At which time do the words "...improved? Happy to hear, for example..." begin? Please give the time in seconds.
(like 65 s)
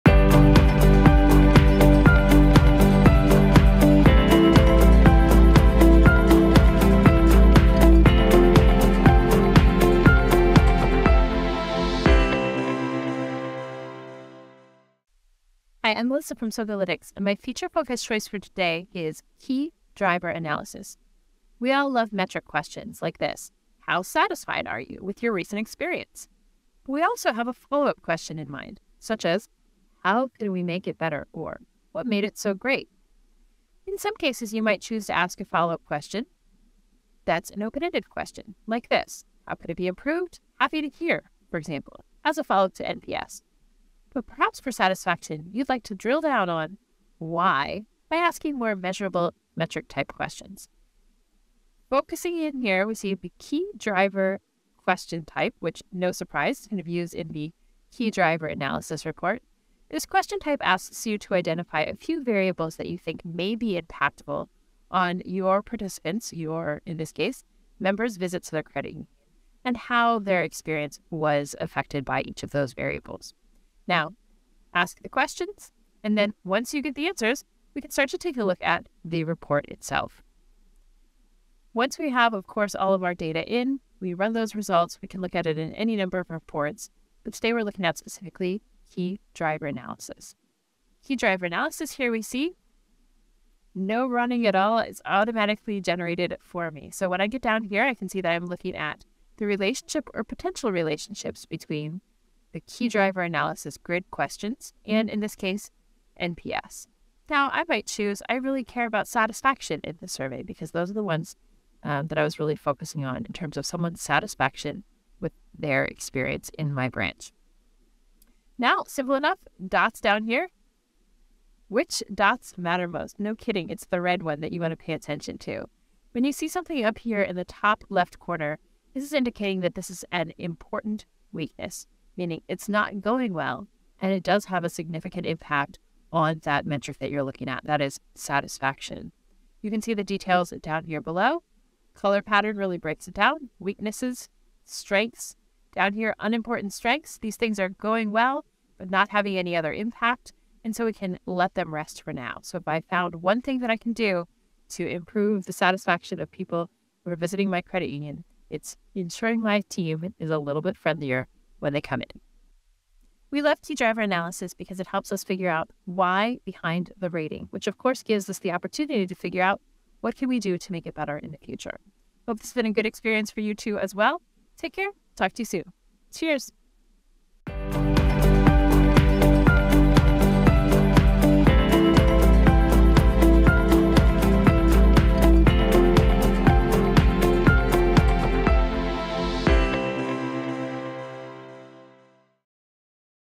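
39 s.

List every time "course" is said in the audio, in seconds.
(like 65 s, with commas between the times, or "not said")
82 s, 167 s.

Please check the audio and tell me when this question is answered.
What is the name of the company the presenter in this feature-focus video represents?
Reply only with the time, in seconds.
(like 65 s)
16 s.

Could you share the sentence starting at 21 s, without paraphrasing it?
We all love metric questions like this How satisfied are you with your recent experience?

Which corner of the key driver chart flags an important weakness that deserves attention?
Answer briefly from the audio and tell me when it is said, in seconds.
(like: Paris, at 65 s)
top left, at 127 s.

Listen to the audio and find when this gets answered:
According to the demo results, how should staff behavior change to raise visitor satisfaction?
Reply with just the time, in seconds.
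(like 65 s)
160 s.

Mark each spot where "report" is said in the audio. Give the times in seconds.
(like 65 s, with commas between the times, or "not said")
59 s, 79 s, 86 s.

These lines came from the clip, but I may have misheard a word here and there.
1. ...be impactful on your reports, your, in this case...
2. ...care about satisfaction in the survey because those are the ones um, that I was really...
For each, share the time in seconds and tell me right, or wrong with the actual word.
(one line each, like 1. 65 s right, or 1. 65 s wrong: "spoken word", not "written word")
1. 63 s wrong: "participants", not "reports"
2. 108 s right.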